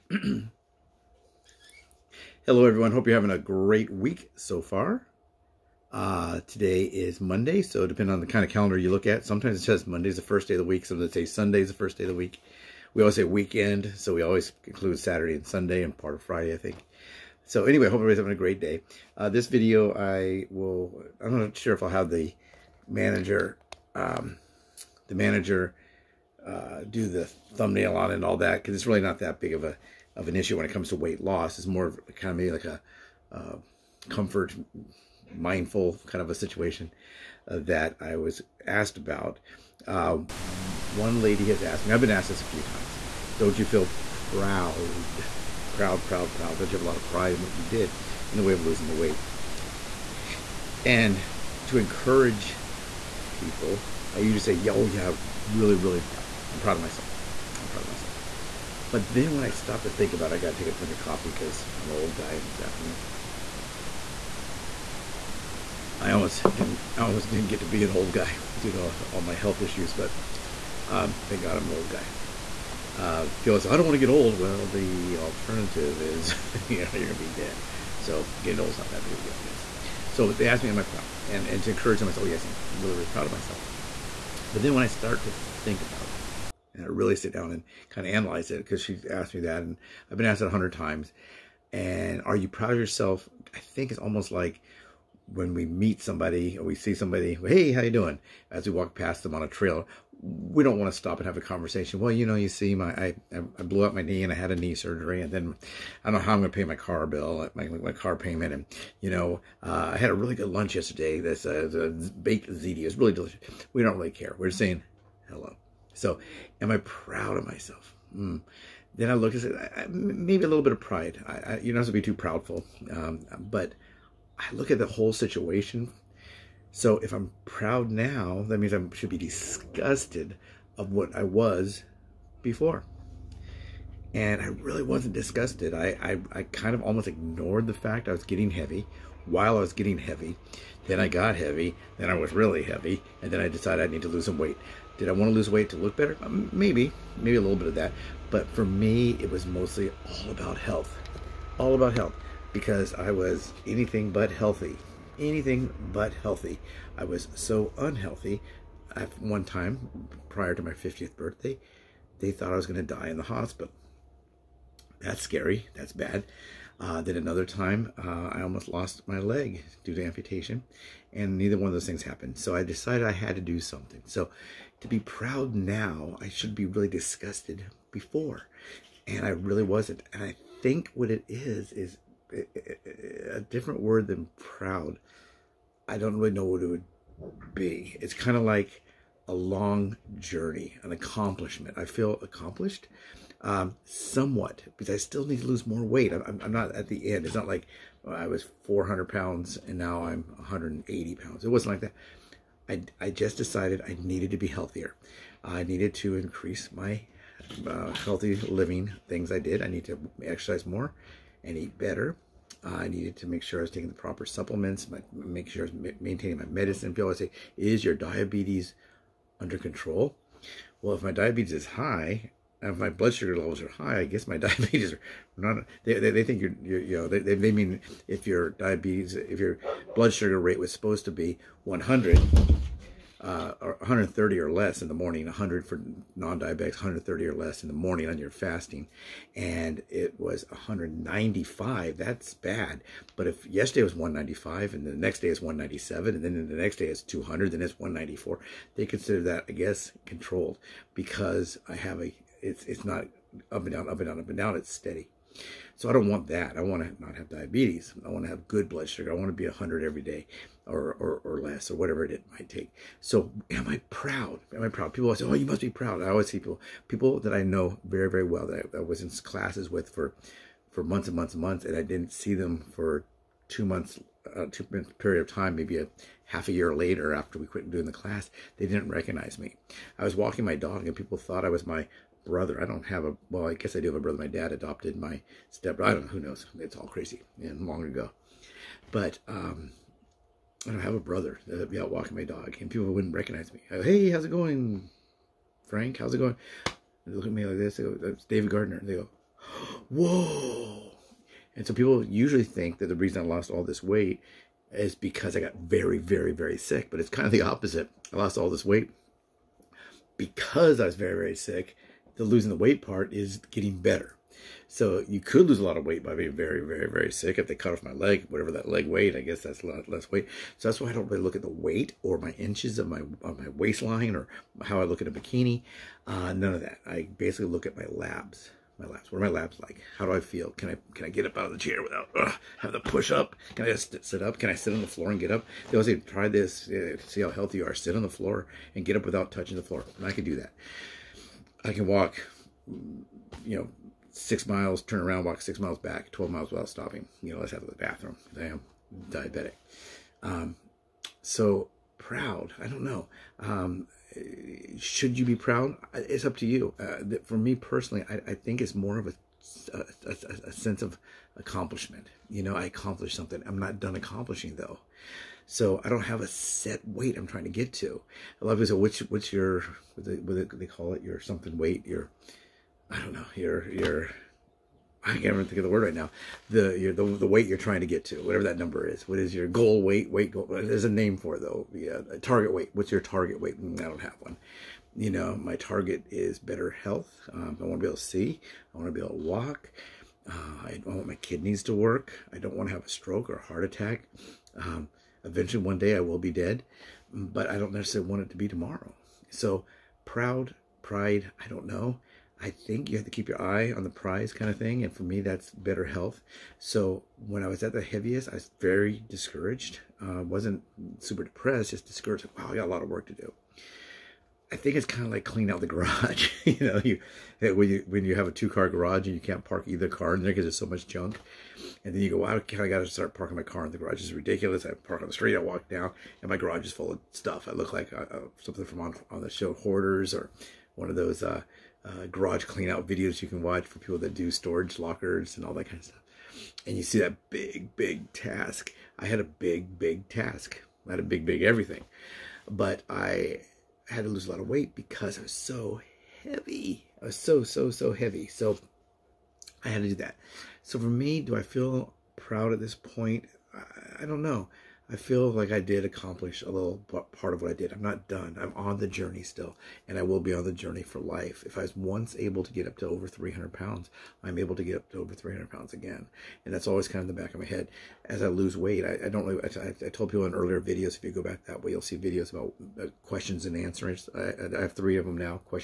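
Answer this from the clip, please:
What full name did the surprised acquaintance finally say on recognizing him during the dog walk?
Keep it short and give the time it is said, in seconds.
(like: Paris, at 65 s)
David Gardner, at 298 s.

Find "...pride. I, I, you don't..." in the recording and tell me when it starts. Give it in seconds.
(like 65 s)
120 s.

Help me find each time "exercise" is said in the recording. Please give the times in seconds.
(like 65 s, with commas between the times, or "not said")
210 s.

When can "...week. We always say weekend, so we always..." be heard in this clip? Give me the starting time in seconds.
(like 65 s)
12 s.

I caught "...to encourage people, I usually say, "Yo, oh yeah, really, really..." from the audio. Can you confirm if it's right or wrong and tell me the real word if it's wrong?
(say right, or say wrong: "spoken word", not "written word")
right.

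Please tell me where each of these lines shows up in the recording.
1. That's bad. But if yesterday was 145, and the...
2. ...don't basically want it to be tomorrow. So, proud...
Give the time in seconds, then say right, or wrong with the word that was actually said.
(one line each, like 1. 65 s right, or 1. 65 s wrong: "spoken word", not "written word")
1. 241 s wrong: "195", not "145"
2. 397 s wrong: "necessarily", not "basically".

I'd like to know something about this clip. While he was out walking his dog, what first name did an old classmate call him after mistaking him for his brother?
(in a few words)
Frank.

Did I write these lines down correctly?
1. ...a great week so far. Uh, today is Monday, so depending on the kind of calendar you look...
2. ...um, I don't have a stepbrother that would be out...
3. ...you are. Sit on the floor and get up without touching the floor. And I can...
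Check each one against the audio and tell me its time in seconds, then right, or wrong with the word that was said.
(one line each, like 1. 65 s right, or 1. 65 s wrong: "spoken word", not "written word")
1. 3 s right
2. 289 s wrong: "brother", not "stepbrother"
3. 337 s right.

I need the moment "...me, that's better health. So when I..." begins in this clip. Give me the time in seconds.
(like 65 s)
405 s.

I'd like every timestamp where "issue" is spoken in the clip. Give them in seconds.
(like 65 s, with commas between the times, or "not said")
30 s, 69 s.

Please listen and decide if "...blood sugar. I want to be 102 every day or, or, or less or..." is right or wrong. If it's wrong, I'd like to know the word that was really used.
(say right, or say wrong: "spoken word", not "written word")
wrong: "100", not "102".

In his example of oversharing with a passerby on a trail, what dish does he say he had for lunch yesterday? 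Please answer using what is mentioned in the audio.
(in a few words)
baked ziti.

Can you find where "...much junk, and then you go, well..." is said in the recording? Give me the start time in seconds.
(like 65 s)
420 s.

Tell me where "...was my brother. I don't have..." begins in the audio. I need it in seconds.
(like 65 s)
281 s.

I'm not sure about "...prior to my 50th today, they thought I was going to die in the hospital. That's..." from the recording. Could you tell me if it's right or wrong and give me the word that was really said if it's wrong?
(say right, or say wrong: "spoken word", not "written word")
wrong: "birthday", not "today".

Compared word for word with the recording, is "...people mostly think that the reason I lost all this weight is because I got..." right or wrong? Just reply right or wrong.
wrong.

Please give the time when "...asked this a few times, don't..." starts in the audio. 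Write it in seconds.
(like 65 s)
42 s.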